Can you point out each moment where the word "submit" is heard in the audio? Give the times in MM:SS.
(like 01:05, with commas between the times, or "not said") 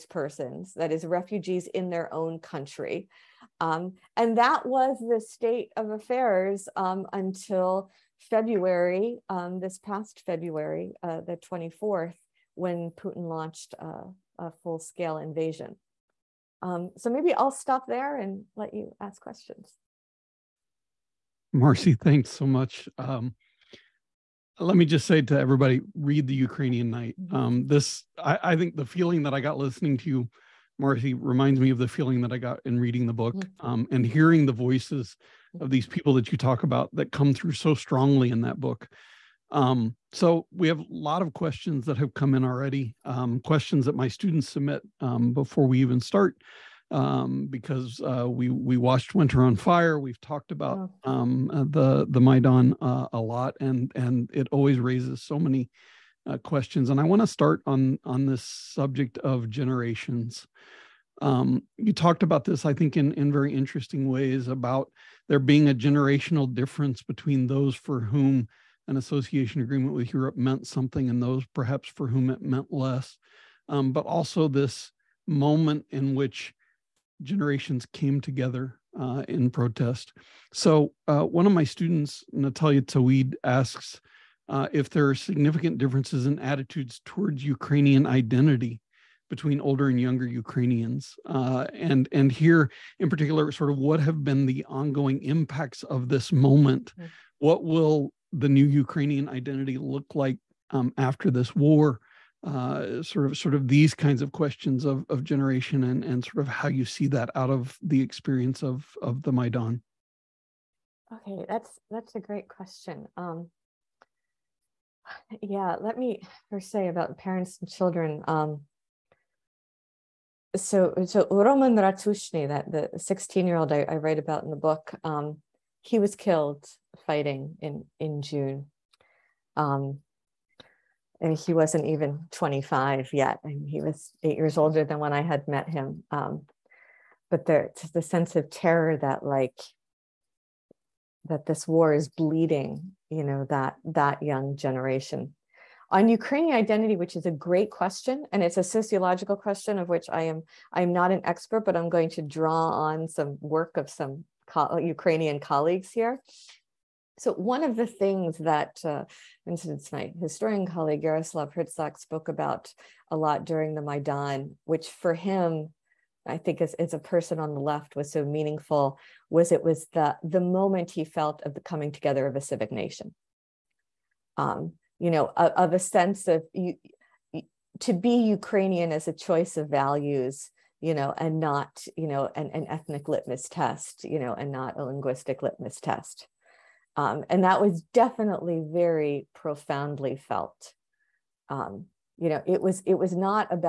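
00:44.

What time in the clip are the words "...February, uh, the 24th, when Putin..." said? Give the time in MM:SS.
00:10.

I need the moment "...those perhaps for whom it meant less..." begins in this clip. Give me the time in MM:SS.
01:11.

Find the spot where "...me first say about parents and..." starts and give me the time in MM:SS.
01:55.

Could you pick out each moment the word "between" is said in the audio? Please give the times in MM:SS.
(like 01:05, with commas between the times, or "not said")
01:07, 01:29.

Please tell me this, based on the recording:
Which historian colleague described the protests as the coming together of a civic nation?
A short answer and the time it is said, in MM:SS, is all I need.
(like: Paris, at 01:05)
Yaroslav Hrytsak, at 02:41.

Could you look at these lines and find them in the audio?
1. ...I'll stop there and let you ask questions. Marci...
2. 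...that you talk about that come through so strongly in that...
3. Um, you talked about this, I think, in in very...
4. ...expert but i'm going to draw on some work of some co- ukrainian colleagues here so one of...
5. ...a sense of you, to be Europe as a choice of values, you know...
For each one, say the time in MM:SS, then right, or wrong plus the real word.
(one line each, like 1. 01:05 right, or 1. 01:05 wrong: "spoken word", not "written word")
1. 00:17 right
2. 00:36 right
3. 01:01 right
4. 02:31 right
5. 02:55 wrong: "Ukrainian", not "Europe".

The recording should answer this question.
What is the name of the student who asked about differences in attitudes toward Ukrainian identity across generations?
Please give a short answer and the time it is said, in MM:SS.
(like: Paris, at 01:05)
Natalia Tawid, at 01:22.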